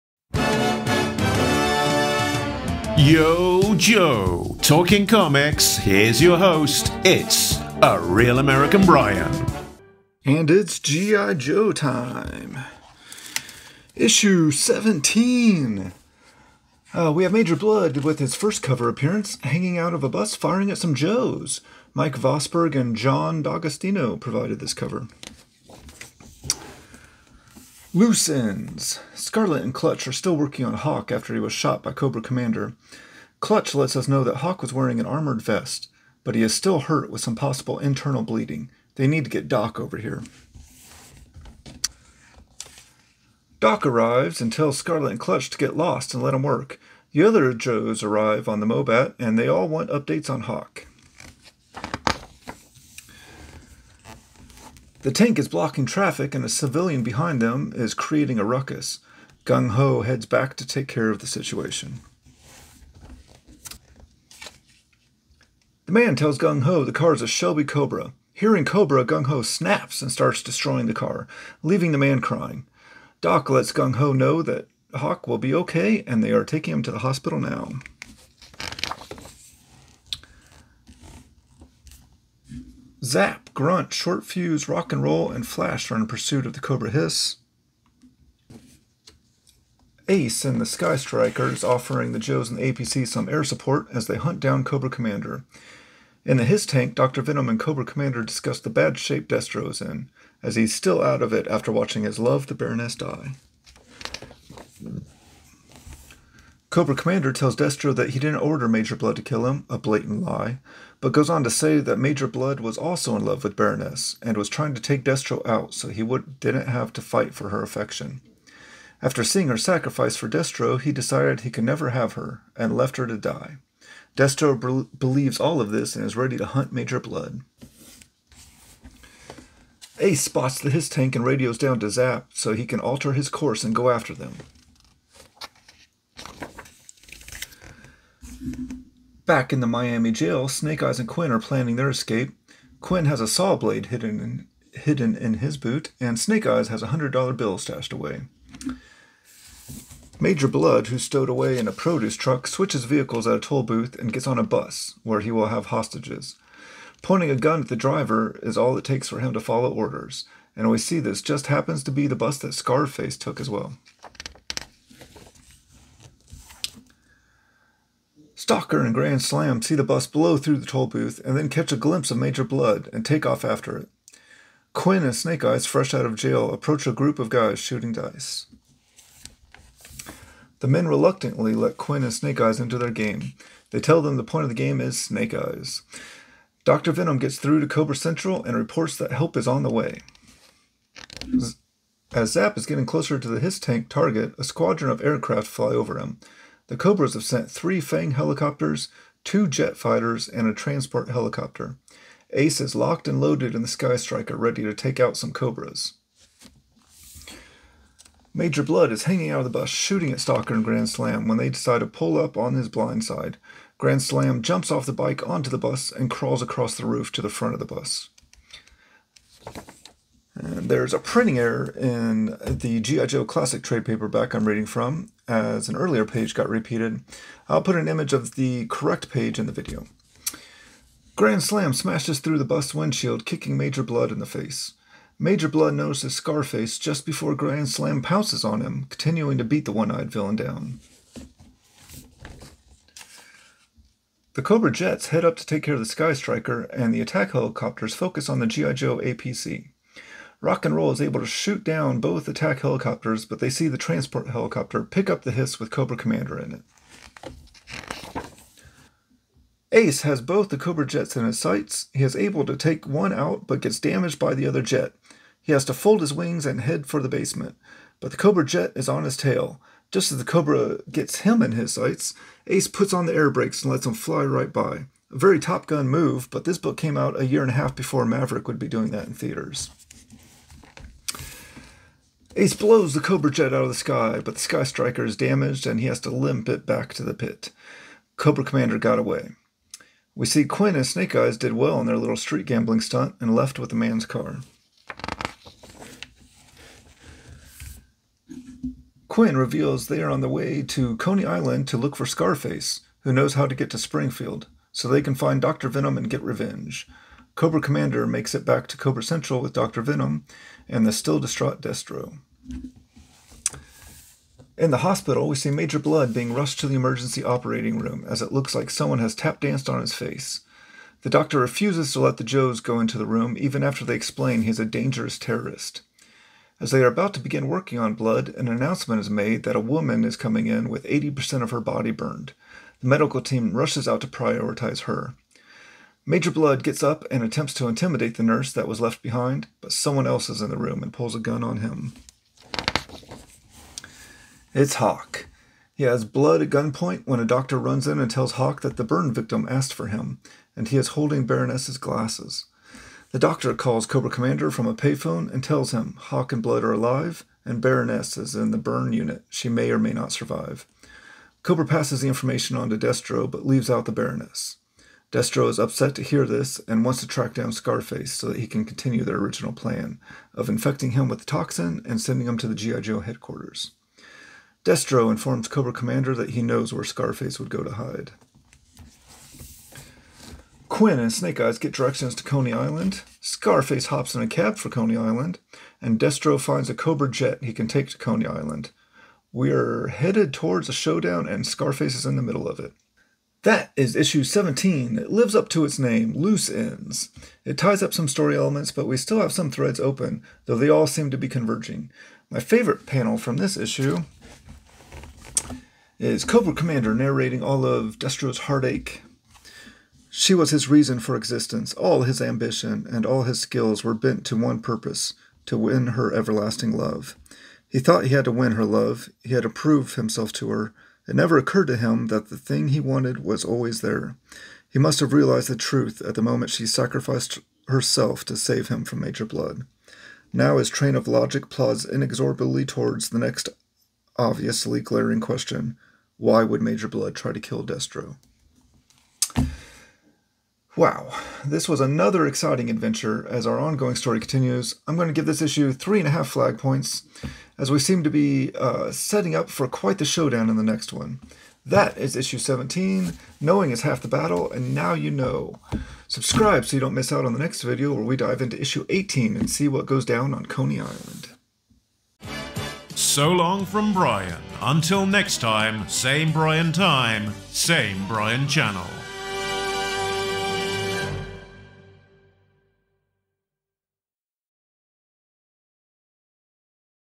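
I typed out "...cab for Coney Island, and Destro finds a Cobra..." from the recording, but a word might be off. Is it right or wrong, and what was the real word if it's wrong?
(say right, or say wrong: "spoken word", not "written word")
right.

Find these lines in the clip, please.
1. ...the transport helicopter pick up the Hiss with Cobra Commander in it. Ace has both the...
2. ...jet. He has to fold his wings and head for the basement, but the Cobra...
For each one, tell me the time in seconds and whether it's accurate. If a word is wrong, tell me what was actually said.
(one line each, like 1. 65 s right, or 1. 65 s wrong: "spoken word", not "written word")
1. 253 s right
2. 264 s right.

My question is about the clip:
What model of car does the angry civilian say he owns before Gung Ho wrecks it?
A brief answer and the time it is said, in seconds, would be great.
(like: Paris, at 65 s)
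Shelby Cobra, at 67 s.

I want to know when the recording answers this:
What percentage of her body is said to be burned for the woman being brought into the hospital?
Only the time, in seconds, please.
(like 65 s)
330 s.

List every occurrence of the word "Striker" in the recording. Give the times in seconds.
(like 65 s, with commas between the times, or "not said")
90 s, 203 s, 246 s, 284 s.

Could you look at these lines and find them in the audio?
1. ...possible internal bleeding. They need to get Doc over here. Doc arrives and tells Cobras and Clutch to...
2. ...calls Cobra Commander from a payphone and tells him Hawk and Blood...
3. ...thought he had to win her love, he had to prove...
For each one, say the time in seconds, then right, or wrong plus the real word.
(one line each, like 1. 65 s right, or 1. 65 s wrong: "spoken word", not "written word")
1. 37 s wrong: "Scarlett", not "Cobras"
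2. 353 s right
3. 417 s right.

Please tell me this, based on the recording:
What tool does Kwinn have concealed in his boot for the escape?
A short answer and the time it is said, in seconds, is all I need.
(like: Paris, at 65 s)
Saw blade, at 143 s.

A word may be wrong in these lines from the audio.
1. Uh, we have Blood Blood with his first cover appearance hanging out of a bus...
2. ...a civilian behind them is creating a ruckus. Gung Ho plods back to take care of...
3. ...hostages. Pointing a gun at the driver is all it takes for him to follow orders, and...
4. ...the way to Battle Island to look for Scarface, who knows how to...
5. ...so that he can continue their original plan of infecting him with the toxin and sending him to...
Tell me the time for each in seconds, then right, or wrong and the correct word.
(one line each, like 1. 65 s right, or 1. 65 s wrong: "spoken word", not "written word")
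1. 16 s wrong: "Major", not "Blood"
2. 56 s wrong: "heads", not "plods"
3. 155 s right
4. 300 s wrong: "Coney", not "Battle"
5. 368 s right.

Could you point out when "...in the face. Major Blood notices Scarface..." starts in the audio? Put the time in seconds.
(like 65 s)
234 s.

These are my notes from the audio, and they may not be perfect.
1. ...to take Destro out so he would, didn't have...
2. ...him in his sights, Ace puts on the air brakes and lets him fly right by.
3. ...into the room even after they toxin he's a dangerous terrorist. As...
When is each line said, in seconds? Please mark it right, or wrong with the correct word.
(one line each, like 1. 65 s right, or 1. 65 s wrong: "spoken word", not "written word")
1. 114 s right
2. 271 s right
3. 322 s wrong: "explain", not "toxin".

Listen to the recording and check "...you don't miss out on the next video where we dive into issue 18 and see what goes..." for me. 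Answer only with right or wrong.
right.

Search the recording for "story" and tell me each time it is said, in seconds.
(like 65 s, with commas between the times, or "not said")
398 s, 443 s.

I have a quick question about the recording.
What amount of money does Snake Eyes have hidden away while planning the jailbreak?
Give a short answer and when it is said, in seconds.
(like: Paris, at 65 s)
$100, at 146 s.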